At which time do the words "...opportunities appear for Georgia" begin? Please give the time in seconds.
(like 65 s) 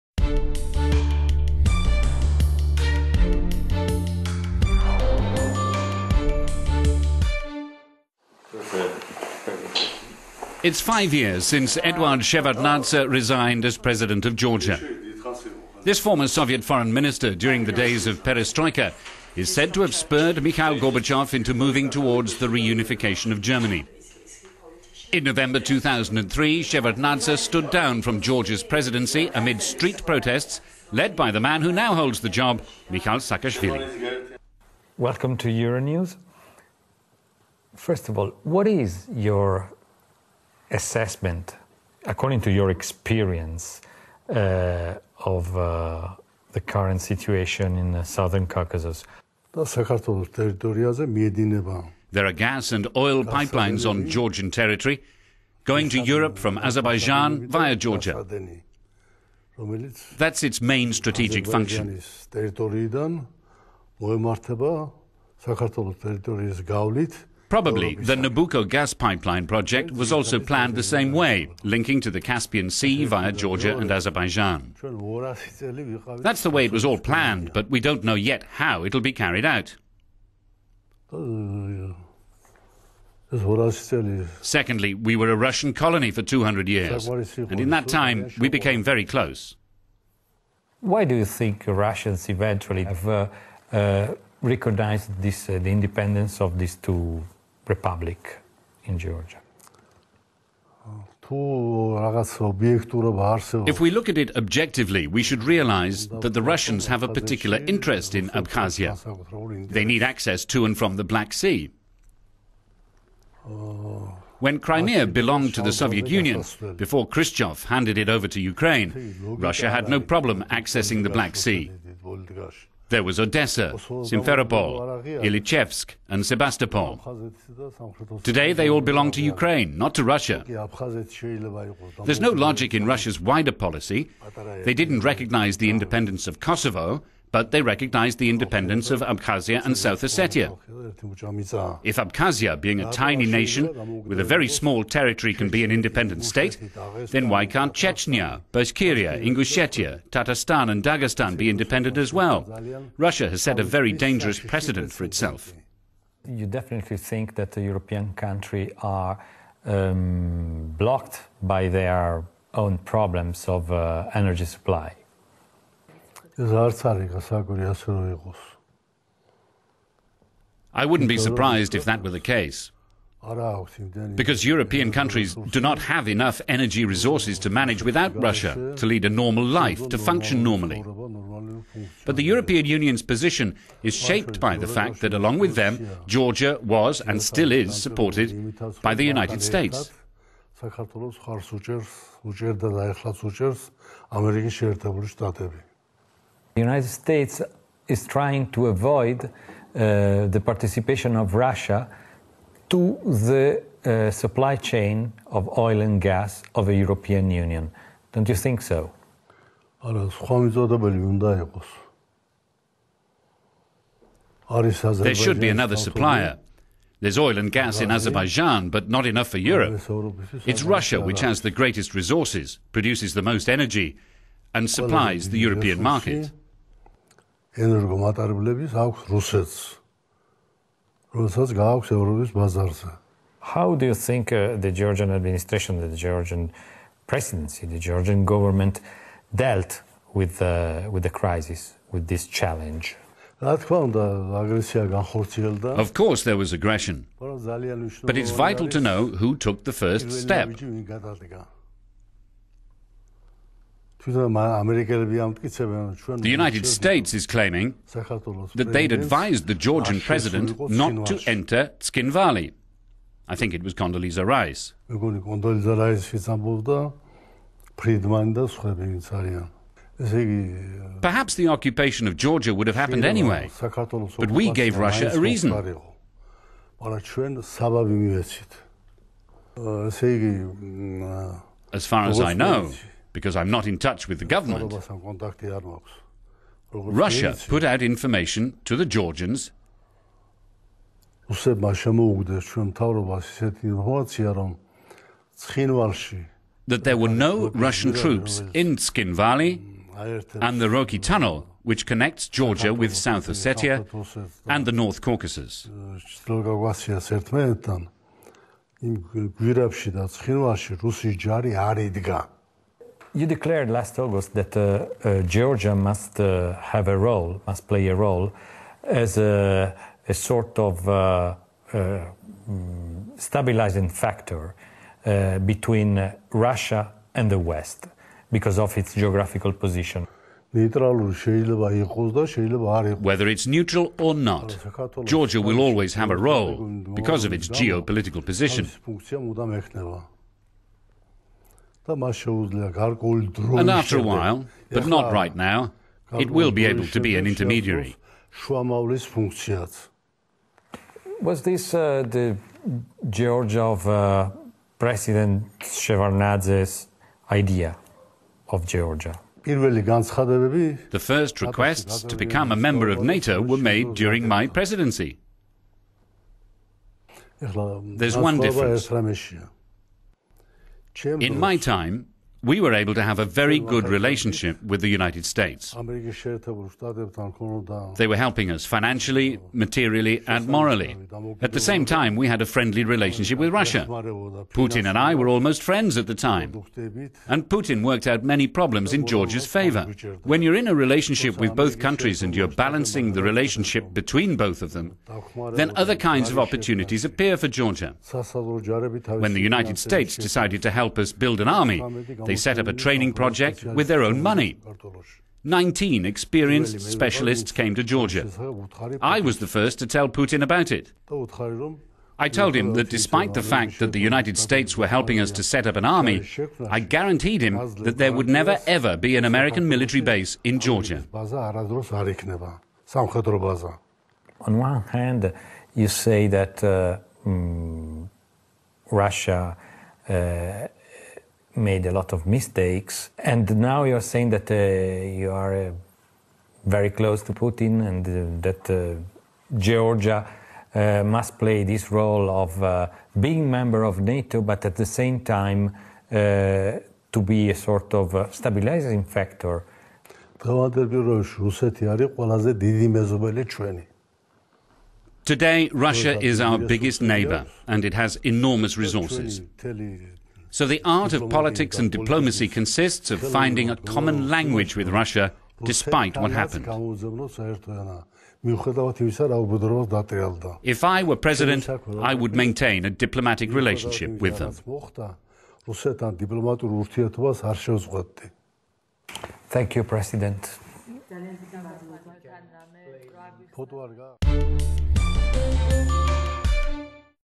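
396 s.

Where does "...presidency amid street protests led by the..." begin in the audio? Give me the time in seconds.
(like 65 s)
28 s.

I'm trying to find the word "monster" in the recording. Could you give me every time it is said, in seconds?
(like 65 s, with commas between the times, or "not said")
not said.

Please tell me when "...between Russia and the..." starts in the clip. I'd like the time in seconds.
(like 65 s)
325 s.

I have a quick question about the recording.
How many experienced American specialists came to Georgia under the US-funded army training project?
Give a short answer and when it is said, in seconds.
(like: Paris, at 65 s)
19, at 405 s.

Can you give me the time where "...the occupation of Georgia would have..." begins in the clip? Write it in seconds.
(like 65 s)
271 s.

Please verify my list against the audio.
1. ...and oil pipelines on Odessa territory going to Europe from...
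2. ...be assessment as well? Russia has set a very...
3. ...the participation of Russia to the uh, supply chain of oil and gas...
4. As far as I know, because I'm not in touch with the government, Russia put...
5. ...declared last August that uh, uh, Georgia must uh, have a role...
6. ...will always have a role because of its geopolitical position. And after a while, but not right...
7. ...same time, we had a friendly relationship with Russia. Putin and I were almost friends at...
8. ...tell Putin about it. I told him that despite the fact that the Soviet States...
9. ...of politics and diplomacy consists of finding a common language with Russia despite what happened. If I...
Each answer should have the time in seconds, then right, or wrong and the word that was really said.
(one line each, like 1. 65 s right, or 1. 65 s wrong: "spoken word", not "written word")
1. 52 s wrong: "Georgian", not "Odessa"
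2. 151 s wrong: "independent", not "assessment"
3. 200 s right
4. 281 s right
5. 313 s right
6. 335 s right
7. 381 s right
8. 409 s wrong: "United", not "Soviet"
9. 461 s right.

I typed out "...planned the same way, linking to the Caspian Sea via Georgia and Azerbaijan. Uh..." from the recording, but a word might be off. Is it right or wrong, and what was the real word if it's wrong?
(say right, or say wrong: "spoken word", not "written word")
right.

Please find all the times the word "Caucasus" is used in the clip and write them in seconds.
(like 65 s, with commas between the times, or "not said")
48 s, 305 s.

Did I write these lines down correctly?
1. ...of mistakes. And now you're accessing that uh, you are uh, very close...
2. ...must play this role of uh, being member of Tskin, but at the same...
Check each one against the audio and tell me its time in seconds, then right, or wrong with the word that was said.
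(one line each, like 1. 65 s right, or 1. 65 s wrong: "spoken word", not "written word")
1. 432 s wrong: "saying", not "accessing"
2. 441 s wrong: "NATO", not "Tskin".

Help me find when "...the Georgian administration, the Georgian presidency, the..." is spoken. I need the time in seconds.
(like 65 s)
234 s.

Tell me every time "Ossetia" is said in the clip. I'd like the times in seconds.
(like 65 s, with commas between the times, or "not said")
140 s, 303 s.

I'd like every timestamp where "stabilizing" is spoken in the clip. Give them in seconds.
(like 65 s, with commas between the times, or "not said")
323 s, 448 s.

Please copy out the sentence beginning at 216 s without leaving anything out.
There's oil and gas in Azerbaijan, but not enough for Europe.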